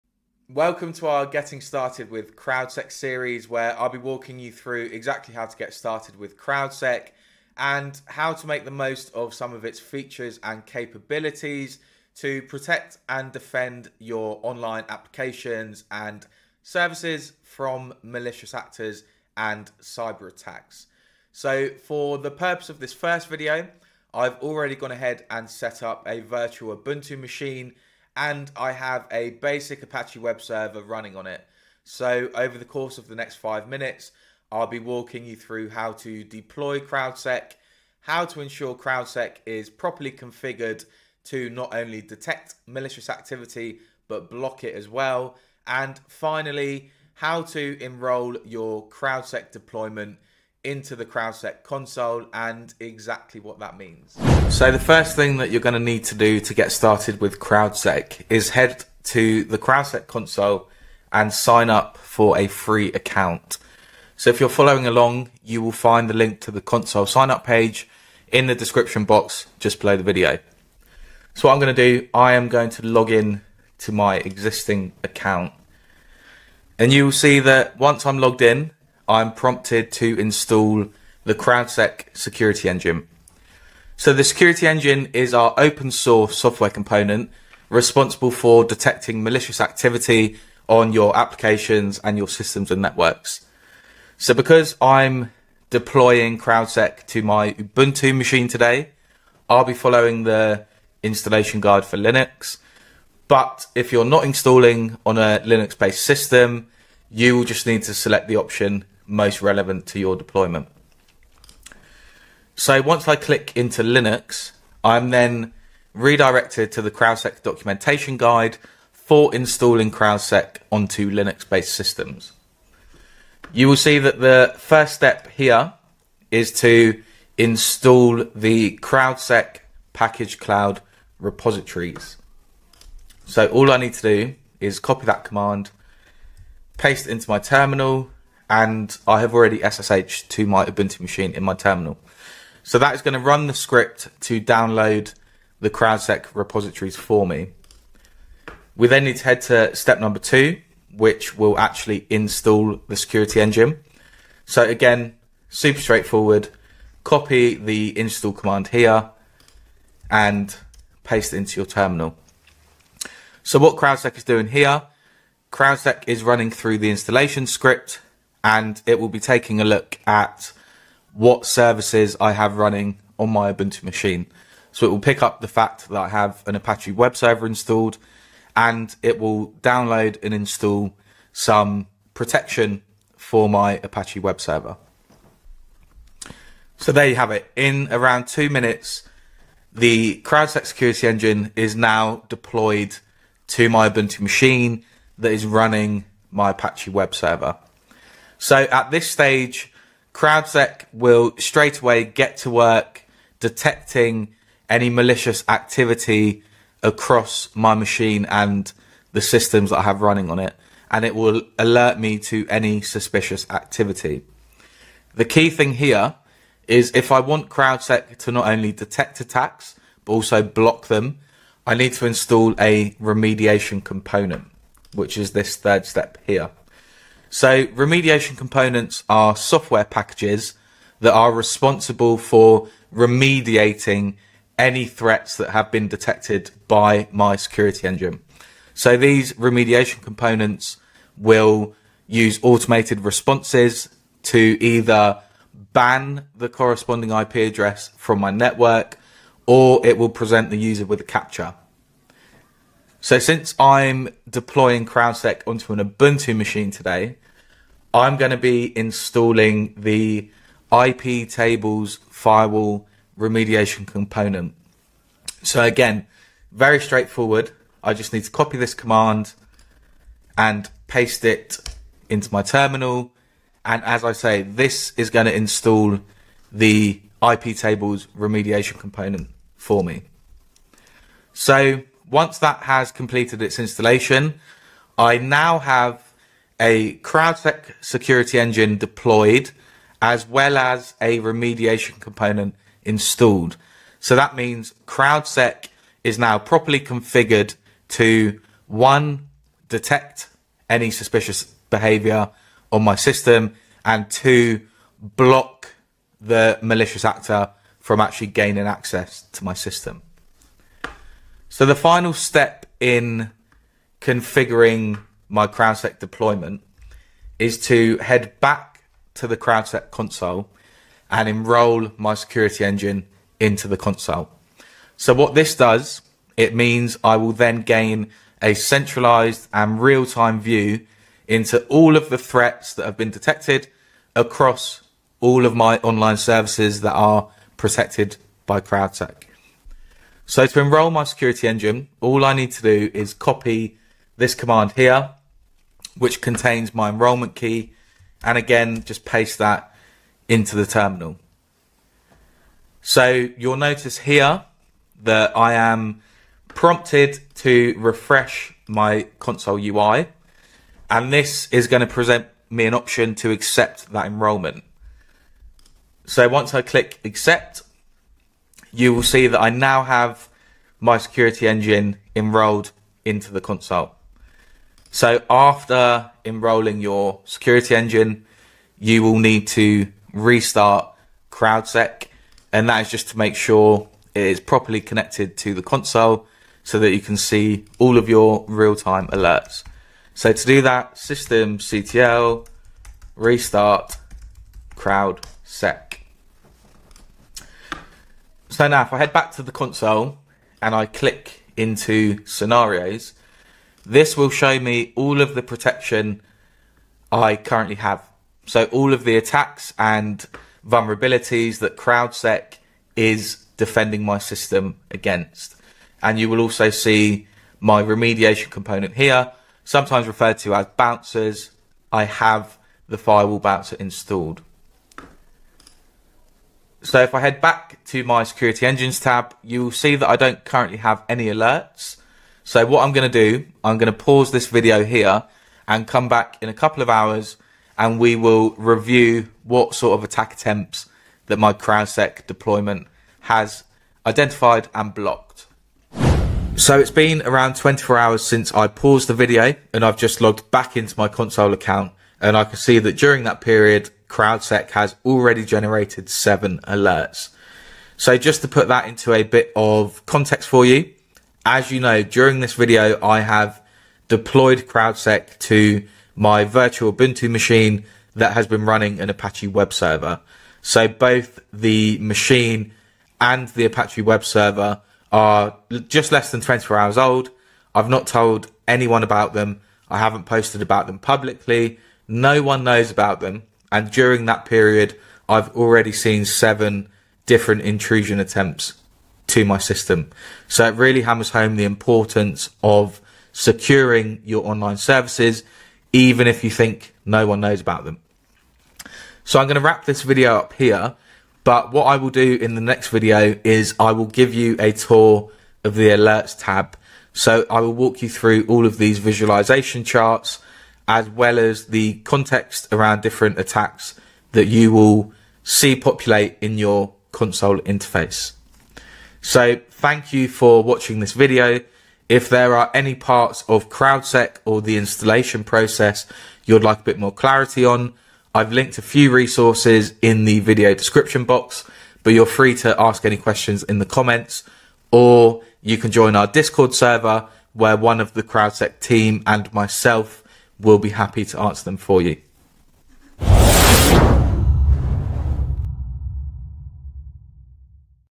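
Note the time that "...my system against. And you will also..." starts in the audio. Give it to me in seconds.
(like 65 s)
414 s.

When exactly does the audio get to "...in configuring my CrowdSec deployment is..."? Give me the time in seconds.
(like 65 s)
312 s.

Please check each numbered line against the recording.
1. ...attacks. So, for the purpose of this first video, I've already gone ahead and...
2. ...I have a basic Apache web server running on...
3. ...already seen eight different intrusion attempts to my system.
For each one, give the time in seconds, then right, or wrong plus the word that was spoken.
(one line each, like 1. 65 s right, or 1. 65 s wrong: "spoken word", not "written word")
1. 20 s right
2. 28 s right
3. 485 s wrong: "seven", not "eight".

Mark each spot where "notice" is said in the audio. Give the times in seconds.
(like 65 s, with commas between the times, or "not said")
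353 s.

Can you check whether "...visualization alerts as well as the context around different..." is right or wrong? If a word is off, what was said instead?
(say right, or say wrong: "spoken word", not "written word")
wrong: "charts", not "alerts".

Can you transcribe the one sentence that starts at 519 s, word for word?
So thank you for watching this video.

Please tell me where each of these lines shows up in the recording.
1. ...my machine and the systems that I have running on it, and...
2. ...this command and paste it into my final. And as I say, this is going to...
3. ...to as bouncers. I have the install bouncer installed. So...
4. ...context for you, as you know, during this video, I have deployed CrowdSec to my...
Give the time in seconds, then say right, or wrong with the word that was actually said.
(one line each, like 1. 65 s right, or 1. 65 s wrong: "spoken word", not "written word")
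1. 207 s right
2. 268 s wrong: "terminal", not "final"
3. 420 s wrong: "firewall", not "install"
4. 460 s right.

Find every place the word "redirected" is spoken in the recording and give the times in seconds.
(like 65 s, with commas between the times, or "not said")
115 s.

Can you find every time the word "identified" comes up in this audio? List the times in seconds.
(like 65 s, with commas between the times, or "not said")
444 s.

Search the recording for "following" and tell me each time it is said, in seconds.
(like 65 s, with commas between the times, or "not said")
64 s, 99 s.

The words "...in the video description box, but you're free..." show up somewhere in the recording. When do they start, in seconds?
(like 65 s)
530 s.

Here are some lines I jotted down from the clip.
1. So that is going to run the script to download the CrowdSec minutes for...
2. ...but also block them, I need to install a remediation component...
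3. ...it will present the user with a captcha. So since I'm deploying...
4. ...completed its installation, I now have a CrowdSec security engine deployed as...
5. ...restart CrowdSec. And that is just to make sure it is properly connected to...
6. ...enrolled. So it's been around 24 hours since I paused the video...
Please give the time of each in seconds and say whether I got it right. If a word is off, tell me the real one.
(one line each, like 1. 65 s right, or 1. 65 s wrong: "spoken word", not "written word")
1. 142 s wrong: "repositories", not "minutes"
2. 220 s right
3. 249 s right
4. 282 s right
5. 380 s right
6. 444 s wrong: "blocked", not "enrolled".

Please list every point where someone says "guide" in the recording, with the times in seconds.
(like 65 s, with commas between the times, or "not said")
101 s, 118 s.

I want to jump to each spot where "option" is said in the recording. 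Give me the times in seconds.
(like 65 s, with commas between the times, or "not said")
108 s, 362 s.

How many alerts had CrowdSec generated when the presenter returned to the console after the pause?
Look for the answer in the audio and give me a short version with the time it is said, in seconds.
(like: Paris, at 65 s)
7, at 456 s.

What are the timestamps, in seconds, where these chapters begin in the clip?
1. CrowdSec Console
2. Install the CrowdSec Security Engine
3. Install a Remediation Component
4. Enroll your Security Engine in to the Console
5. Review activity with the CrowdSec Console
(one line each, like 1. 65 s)
1. 54 s
2. 83 s
3. 226 s
4. 318 s
5. 446 s.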